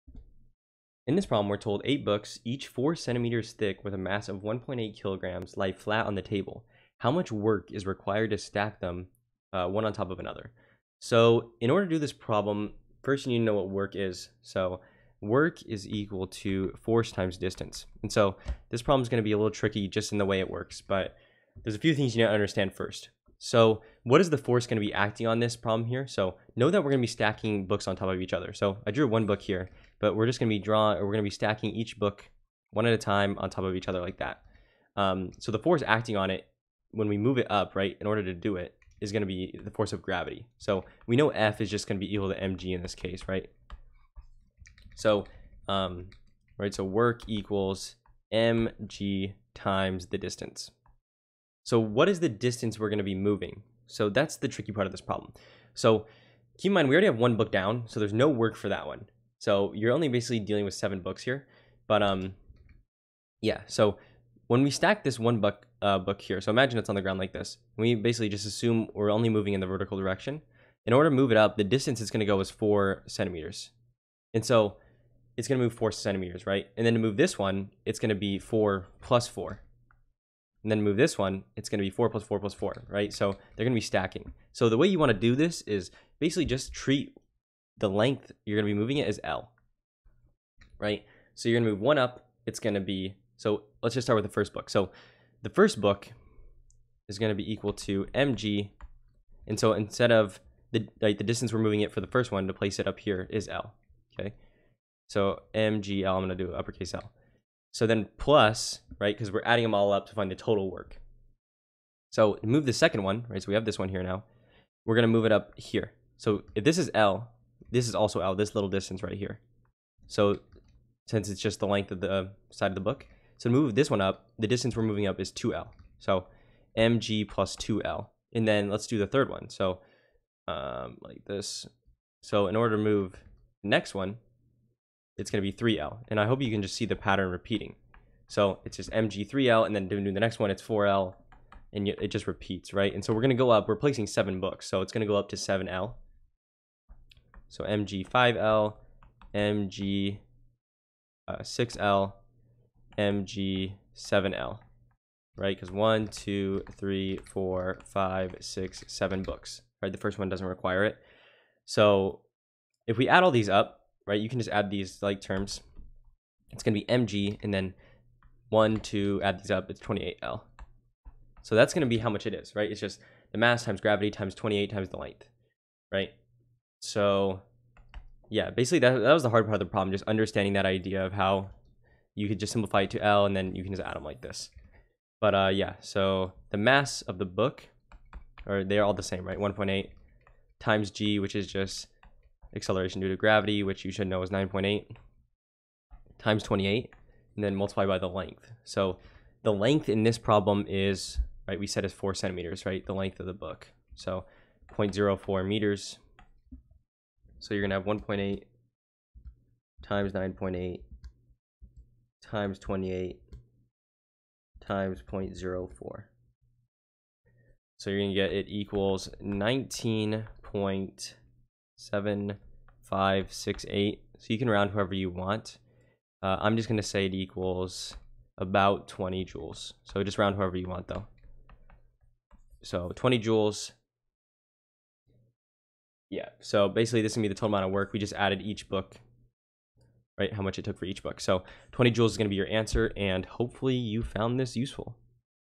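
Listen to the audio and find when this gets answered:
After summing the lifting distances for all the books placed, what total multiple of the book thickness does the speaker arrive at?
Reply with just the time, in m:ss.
2:49.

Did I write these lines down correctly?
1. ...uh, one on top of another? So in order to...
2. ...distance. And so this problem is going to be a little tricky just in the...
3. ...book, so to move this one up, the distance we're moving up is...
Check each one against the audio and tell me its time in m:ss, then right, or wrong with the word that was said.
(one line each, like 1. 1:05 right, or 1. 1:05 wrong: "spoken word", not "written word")
1. 0:09 right
2. 0:17 right
3. 2:02 right.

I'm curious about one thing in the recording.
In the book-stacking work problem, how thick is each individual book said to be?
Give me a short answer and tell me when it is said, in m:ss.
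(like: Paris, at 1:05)
4 centimeters, at 0:02.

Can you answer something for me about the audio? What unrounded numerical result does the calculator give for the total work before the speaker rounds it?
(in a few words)
19.7568.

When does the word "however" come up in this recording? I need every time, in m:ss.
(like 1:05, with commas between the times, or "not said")
3:44, 3:50.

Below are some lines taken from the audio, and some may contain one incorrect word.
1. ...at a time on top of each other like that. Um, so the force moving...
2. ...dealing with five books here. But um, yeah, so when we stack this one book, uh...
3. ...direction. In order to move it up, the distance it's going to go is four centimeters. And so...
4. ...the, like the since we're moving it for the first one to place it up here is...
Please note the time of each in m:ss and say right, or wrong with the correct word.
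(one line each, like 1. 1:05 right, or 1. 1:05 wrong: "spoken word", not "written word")
1. 0:32 wrong: "acting", not "moving"
2. 1:00 wrong: "seven", not "five"
3. 1:09 right
4. 1:40 wrong: "distance", not "since".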